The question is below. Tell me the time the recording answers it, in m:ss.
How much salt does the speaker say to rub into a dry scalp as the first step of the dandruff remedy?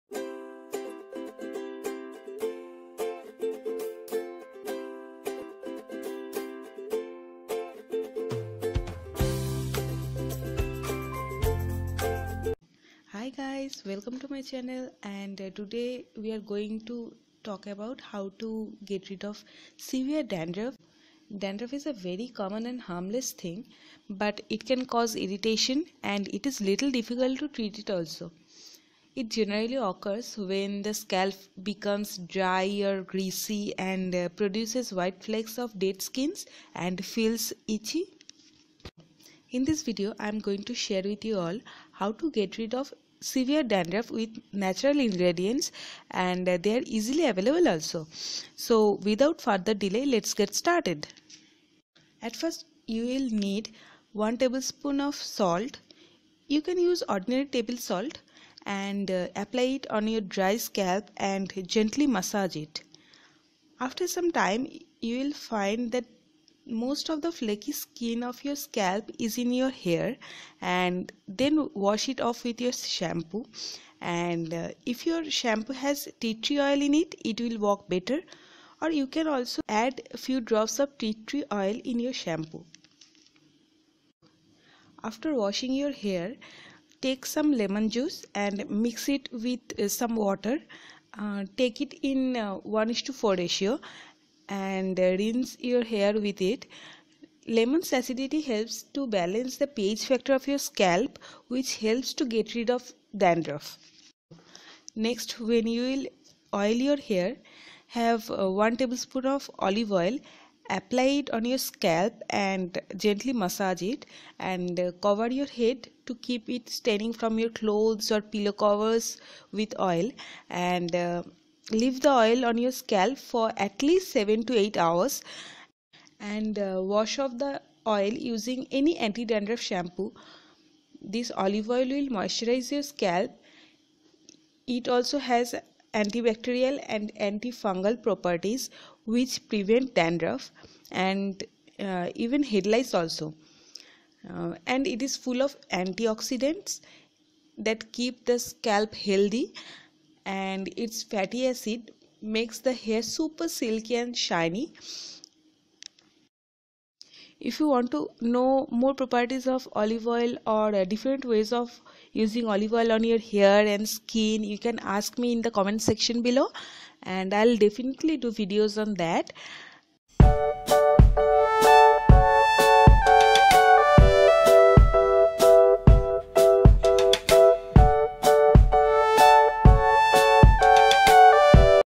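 0:54.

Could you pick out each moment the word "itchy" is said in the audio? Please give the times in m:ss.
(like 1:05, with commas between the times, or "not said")
0:37.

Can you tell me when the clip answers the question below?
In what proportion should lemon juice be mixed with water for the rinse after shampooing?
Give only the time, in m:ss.
1:32.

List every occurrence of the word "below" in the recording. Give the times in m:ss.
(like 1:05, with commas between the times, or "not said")
2:46.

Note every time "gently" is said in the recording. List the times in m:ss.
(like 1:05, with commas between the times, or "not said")
1:01, 1:53.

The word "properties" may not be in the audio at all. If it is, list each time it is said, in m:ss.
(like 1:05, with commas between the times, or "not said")
2:18, 2:38.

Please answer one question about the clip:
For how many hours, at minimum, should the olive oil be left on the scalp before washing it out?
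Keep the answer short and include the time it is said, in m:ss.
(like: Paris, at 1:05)
7 to 8 hours, at 2:04.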